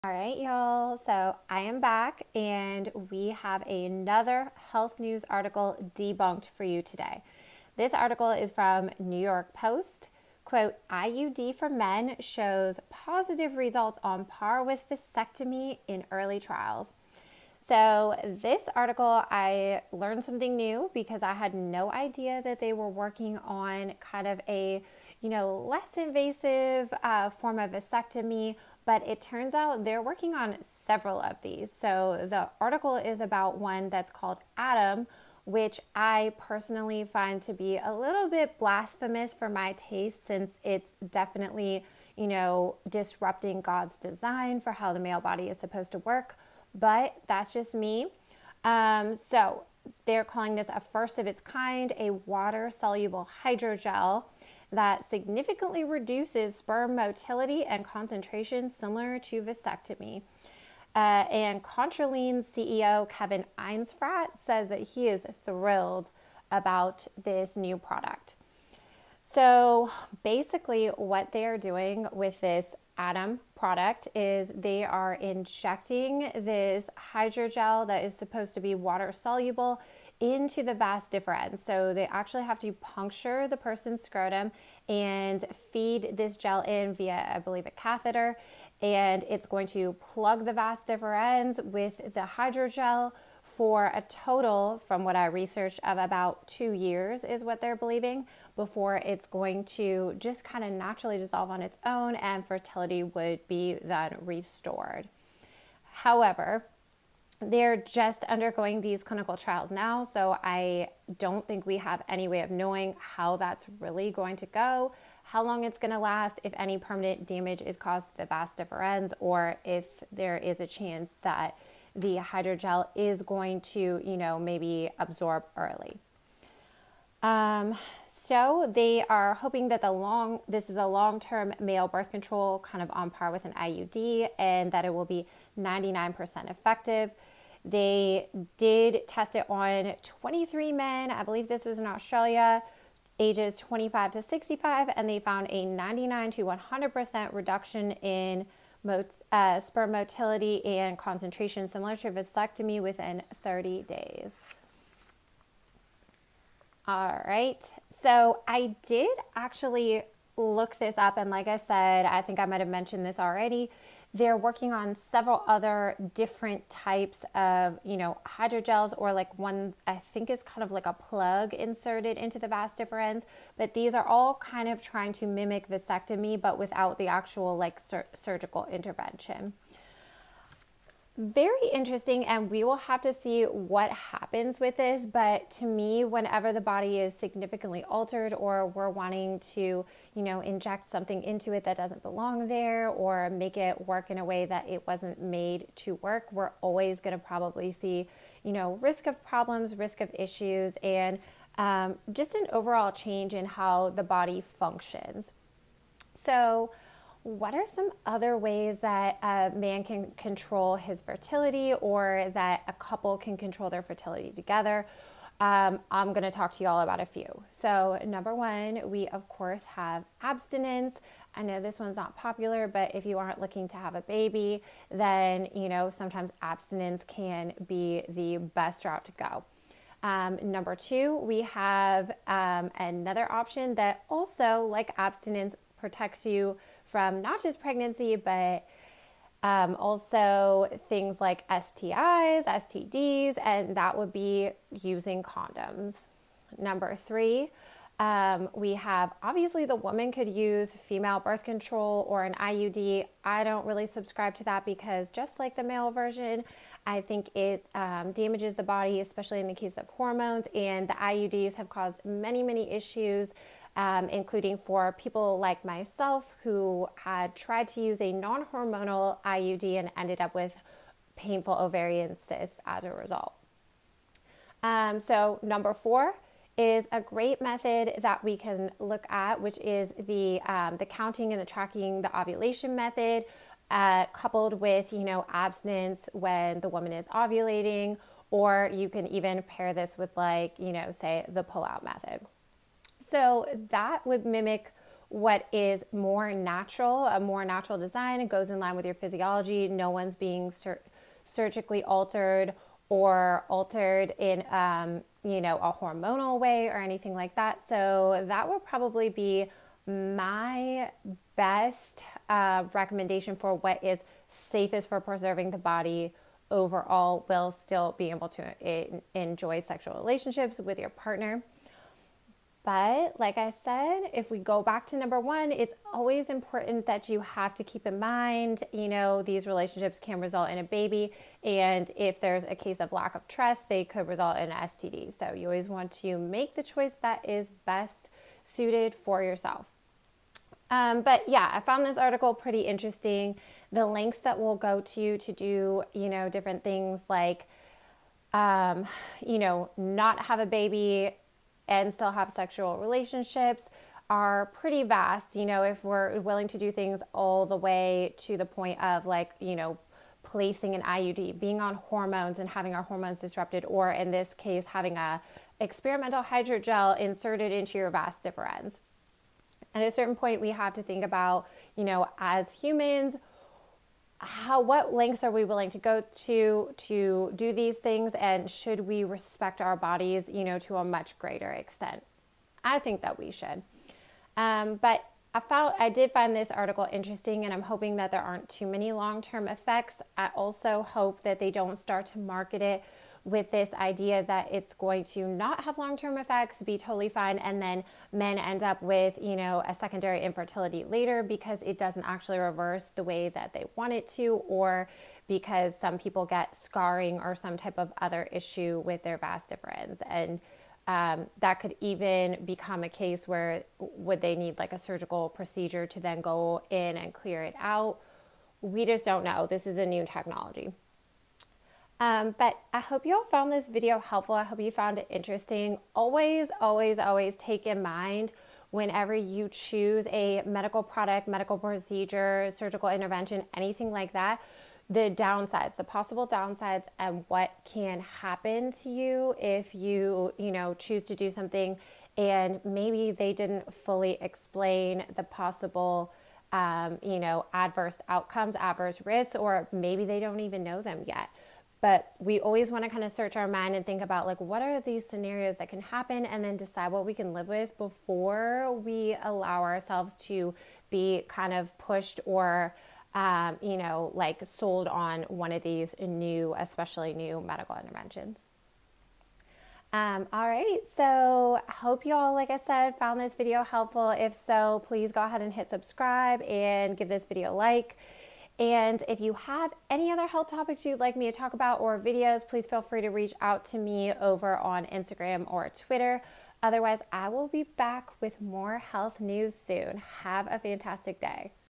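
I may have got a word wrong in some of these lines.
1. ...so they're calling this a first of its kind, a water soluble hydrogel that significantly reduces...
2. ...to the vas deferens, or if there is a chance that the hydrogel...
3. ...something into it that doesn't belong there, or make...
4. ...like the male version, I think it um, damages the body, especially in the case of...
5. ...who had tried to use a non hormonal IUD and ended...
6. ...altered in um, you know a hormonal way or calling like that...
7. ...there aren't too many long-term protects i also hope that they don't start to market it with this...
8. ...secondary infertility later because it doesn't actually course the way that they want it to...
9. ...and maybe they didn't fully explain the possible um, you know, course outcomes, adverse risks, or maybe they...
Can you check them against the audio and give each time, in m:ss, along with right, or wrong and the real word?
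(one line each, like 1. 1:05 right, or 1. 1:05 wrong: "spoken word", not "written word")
1. 0:49 right
2. 1:58 right
3. 3:10 right
4. 4:15 right
5. 4:26 right
6. 5:03 wrong: "anything", not "calling"
7. 6:28 wrong: "effects", not "protects"
8. 6:39 wrong: "reverse", not "course"
9. 7:22 wrong: "adverse", not "course".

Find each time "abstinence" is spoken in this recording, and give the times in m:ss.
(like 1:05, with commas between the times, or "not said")
3:40, 3:46, 3:54, 4:45.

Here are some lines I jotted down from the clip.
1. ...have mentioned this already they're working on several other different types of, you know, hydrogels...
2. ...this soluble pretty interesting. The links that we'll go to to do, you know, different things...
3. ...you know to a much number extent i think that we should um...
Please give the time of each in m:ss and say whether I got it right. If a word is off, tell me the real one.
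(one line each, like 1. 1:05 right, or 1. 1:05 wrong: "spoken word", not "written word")
1. 2:42 right
2. 5:41 wrong: "article", not "soluble"
3. 6:20 wrong: "greater", not "number".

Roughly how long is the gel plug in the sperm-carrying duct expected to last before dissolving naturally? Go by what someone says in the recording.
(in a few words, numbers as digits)
2 years.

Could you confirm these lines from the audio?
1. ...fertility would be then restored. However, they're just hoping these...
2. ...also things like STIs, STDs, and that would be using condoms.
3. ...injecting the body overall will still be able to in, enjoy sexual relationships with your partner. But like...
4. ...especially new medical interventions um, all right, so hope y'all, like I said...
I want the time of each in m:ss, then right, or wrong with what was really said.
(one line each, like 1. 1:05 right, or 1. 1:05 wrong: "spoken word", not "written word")
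1. 1:42 wrong: "undergoing", not "hoping"
2. 3:59 right
3. 5:15 wrong: "preserving", not "injecting"
4. 7:46 right.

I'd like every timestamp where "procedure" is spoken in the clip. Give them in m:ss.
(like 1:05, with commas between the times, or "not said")
6:55, 7:11.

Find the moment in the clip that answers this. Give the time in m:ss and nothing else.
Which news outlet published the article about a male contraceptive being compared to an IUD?
0:08.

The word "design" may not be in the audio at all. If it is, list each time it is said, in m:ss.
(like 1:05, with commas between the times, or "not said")
0:43, 4:57.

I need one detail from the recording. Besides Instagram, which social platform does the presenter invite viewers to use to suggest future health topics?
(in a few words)
Twitter.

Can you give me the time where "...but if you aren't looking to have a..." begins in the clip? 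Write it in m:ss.
3:42.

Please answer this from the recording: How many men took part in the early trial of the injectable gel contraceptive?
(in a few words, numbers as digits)
23.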